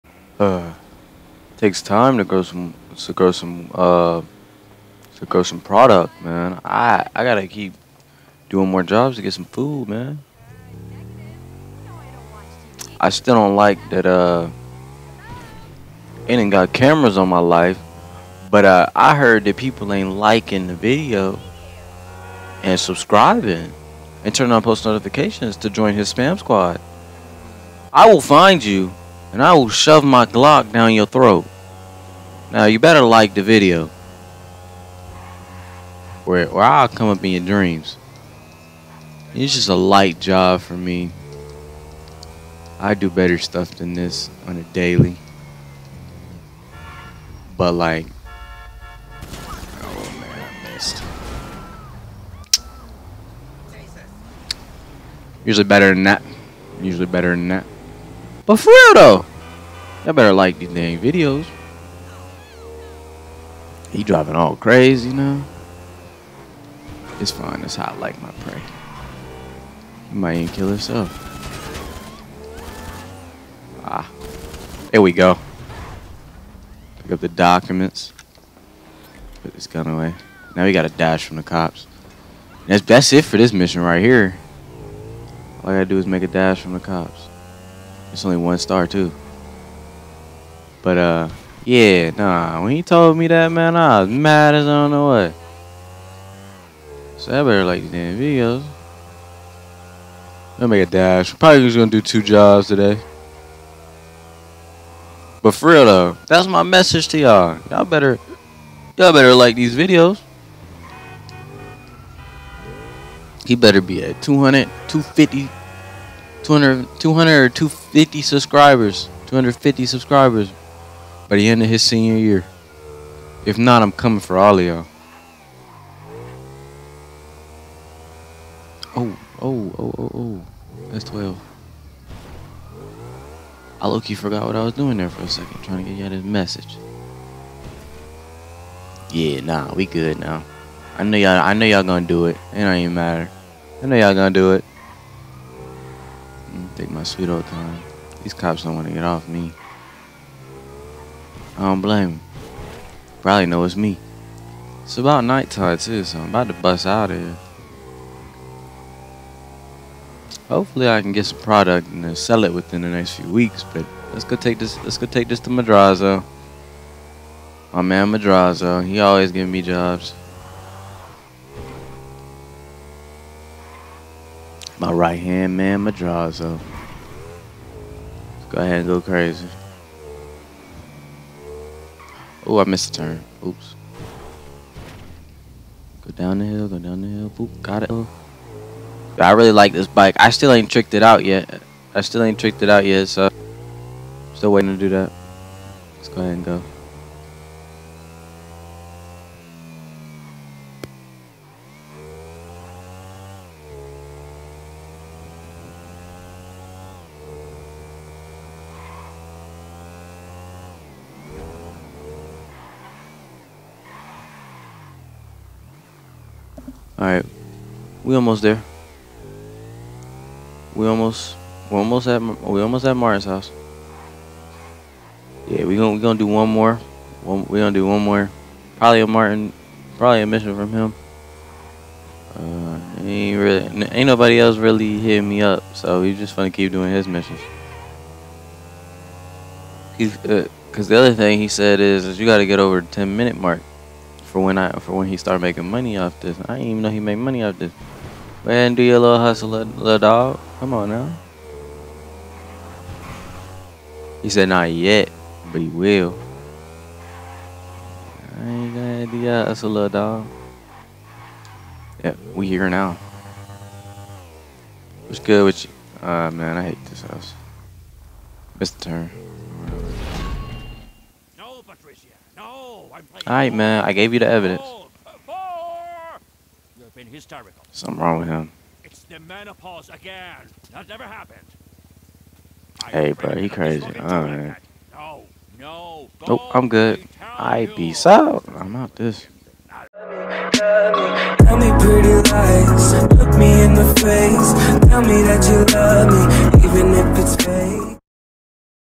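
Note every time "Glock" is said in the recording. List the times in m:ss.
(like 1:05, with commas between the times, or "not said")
0:30.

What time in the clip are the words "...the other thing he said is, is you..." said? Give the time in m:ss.
4:00.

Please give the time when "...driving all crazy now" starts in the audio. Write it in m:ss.
1:04.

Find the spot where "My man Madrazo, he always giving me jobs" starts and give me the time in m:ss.
2:47.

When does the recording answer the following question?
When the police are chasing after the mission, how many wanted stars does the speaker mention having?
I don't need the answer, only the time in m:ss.
1:28.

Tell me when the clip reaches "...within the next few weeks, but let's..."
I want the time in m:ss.
2:42.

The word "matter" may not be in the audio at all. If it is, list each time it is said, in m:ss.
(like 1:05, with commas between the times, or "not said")
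2:22.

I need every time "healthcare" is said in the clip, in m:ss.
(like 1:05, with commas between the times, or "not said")
not said.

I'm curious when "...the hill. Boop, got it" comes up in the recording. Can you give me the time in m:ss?
3:07.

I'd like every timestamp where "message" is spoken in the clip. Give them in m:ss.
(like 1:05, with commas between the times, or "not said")
1:46, 2:16.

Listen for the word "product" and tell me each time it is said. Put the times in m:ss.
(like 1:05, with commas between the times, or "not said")
0:05, 2:41.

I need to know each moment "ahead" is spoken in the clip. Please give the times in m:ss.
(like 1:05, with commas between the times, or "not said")
2:58, 3:16.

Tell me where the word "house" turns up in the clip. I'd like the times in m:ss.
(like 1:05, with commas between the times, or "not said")
3:43, 4:27.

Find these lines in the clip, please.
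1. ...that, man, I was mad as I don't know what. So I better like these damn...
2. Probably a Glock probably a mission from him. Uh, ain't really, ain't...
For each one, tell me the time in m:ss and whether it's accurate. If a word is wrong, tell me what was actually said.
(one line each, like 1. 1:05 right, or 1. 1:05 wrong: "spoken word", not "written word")
1. 1:33 right
2. 3:48 wrong: "Martin", not "Glock".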